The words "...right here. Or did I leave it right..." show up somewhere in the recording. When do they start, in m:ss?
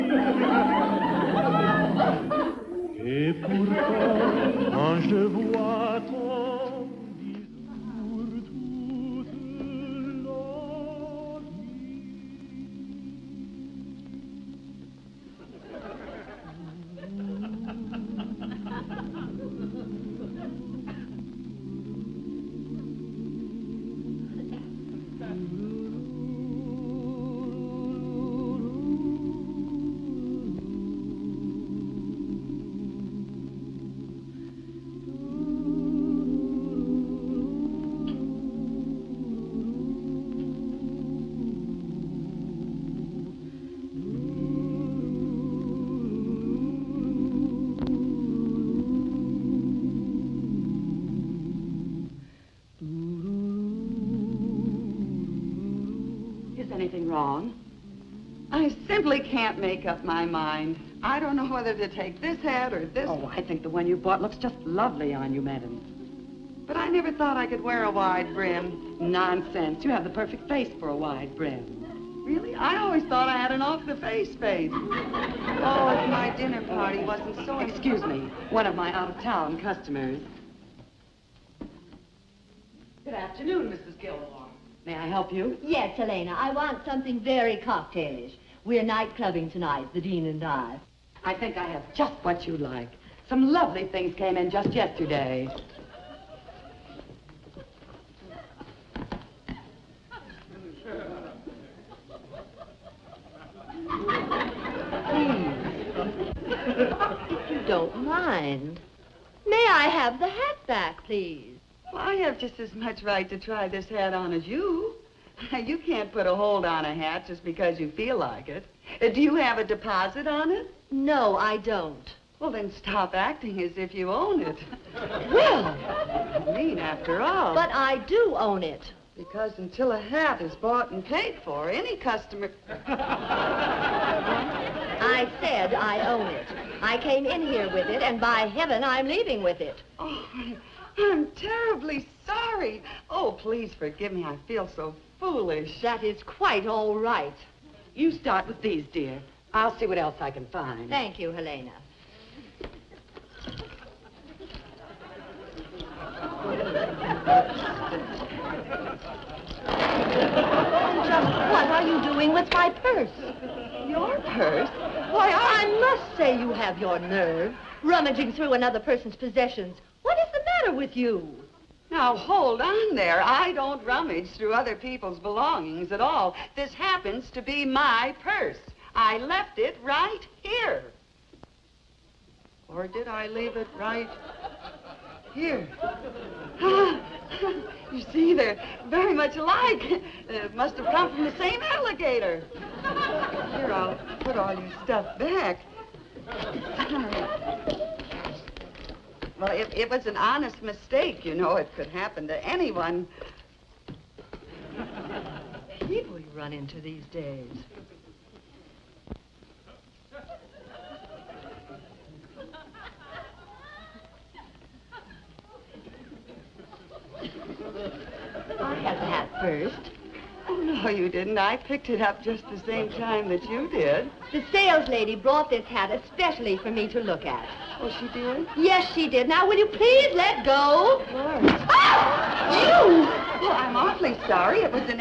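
2:59.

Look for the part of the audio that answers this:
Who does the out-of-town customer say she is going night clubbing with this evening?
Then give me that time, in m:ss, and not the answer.
1:29.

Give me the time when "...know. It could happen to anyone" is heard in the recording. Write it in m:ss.
3:21.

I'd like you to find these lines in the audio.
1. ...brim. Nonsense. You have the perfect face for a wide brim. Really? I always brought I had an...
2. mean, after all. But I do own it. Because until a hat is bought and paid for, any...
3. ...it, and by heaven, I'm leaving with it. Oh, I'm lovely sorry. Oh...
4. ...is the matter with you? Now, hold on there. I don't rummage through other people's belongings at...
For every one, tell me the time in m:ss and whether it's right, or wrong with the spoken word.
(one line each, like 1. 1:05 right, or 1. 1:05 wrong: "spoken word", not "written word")
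1. 1:08 wrong: "thought", not "brought"
2. 2:06 right
3. 2:17 wrong: "terribly", not "lovely"
4. 2:50 right.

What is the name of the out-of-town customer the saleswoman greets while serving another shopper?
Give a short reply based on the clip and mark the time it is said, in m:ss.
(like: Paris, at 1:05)
Mrs. Gilmore, at 1:23.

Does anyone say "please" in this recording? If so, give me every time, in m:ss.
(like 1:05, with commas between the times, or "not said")
1:45, 1:51, 2:23, 3:49.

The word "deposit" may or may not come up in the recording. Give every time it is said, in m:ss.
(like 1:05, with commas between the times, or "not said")
1:59.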